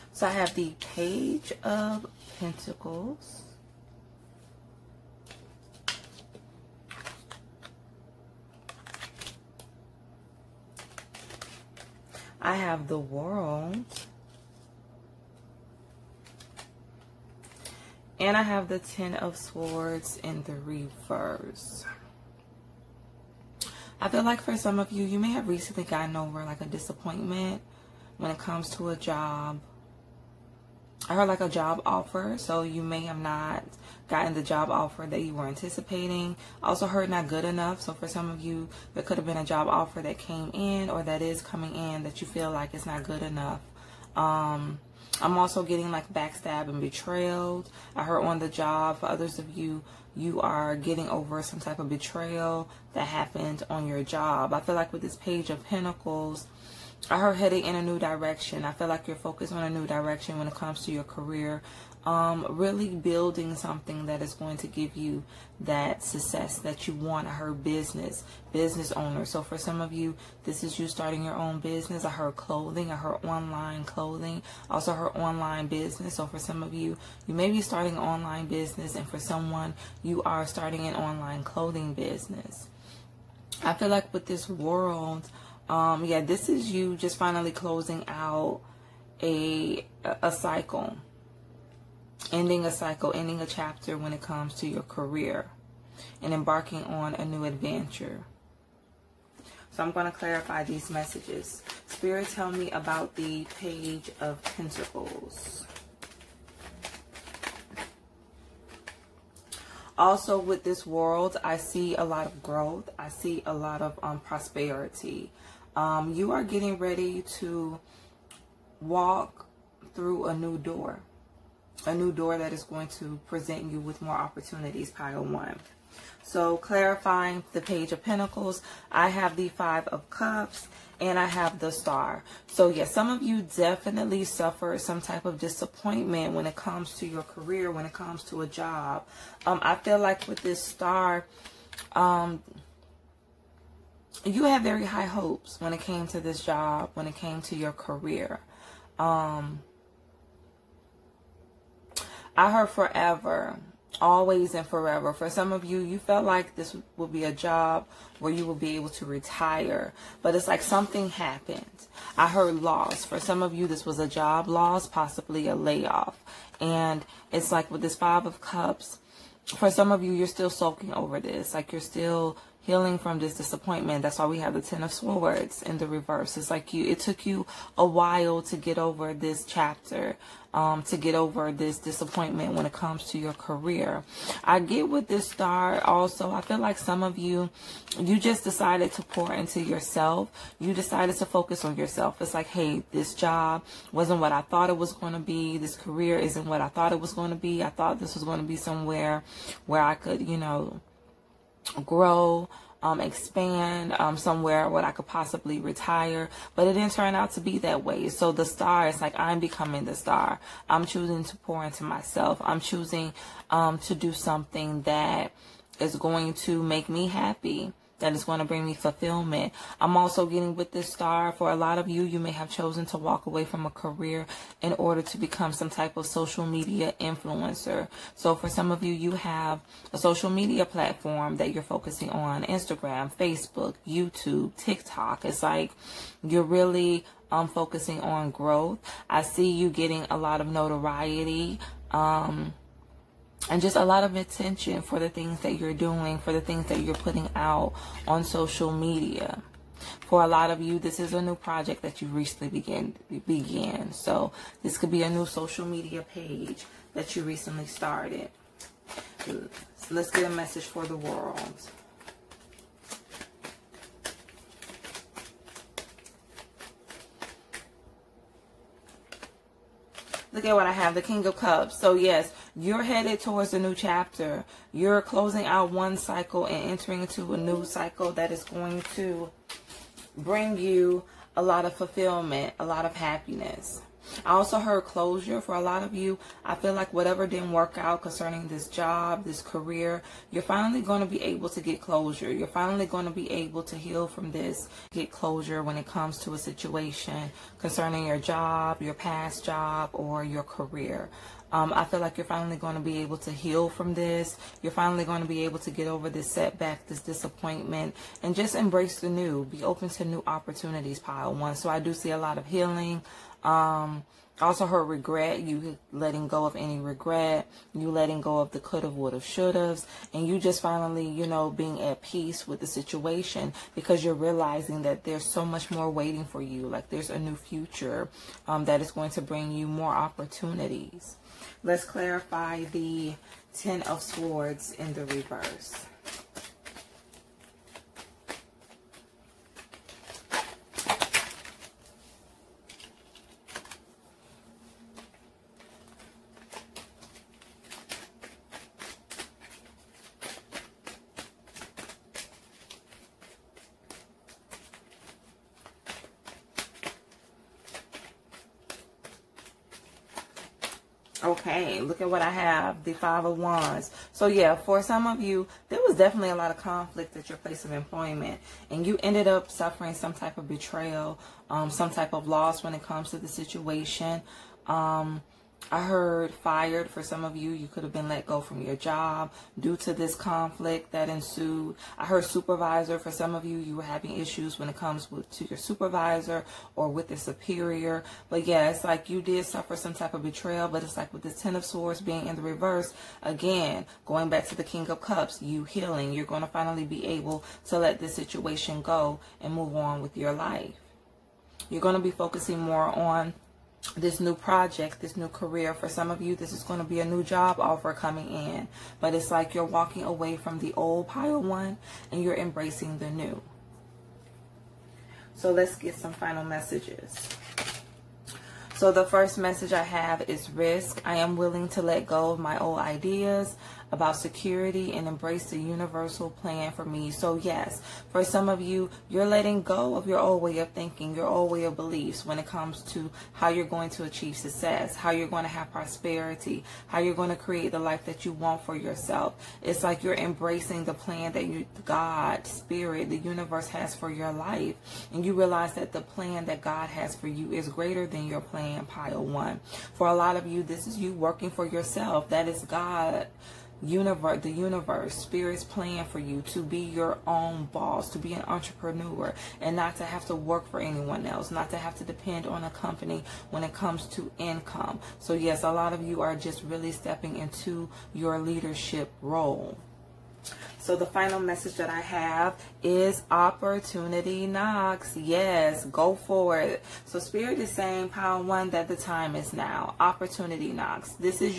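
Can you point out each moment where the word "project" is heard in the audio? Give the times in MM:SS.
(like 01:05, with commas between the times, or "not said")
04:11, 06:44.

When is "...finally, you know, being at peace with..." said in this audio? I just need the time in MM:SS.
05:20.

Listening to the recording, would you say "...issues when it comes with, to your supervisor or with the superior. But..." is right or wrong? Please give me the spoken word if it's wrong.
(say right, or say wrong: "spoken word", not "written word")
right.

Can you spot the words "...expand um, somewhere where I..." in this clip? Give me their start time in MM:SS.
03:22.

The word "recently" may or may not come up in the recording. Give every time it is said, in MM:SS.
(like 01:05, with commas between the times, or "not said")
00:25, 04:12, 04:17.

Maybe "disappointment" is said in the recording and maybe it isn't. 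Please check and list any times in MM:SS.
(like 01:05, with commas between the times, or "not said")
00:26, 02:15, 02:53, 03:01, 05:07.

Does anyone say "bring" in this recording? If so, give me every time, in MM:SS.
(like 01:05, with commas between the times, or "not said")
03:38, 04:40, 05:29.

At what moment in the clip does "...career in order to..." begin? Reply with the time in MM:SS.
03:43.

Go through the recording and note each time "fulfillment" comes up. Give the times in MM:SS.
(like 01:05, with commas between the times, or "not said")
03:38, 04:41.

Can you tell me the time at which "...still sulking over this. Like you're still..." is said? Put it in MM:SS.
02:50.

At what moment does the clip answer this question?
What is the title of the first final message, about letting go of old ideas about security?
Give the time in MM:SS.
07:00.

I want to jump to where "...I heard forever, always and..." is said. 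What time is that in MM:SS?
02:32.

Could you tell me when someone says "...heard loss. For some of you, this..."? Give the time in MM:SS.
02:42.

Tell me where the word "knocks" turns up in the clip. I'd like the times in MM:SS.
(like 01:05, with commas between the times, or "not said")
07:54, 08:00.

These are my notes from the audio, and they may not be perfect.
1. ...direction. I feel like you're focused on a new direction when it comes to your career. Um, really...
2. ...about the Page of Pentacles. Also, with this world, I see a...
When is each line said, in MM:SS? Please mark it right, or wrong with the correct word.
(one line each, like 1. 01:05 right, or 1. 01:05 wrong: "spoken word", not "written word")
1. 00:57 right
2. 01:42 right.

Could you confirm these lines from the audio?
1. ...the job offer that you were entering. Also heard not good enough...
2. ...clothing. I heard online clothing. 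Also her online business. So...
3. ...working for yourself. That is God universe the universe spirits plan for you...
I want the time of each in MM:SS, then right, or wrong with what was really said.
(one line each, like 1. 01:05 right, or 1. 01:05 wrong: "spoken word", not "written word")
1. 00:34 wrong: "anticipating", not "entering"
2. 01:12 right
3. 07:31 right.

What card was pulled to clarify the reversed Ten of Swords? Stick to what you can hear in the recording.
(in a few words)
Five of Wands.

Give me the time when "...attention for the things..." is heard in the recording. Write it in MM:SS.
04:04.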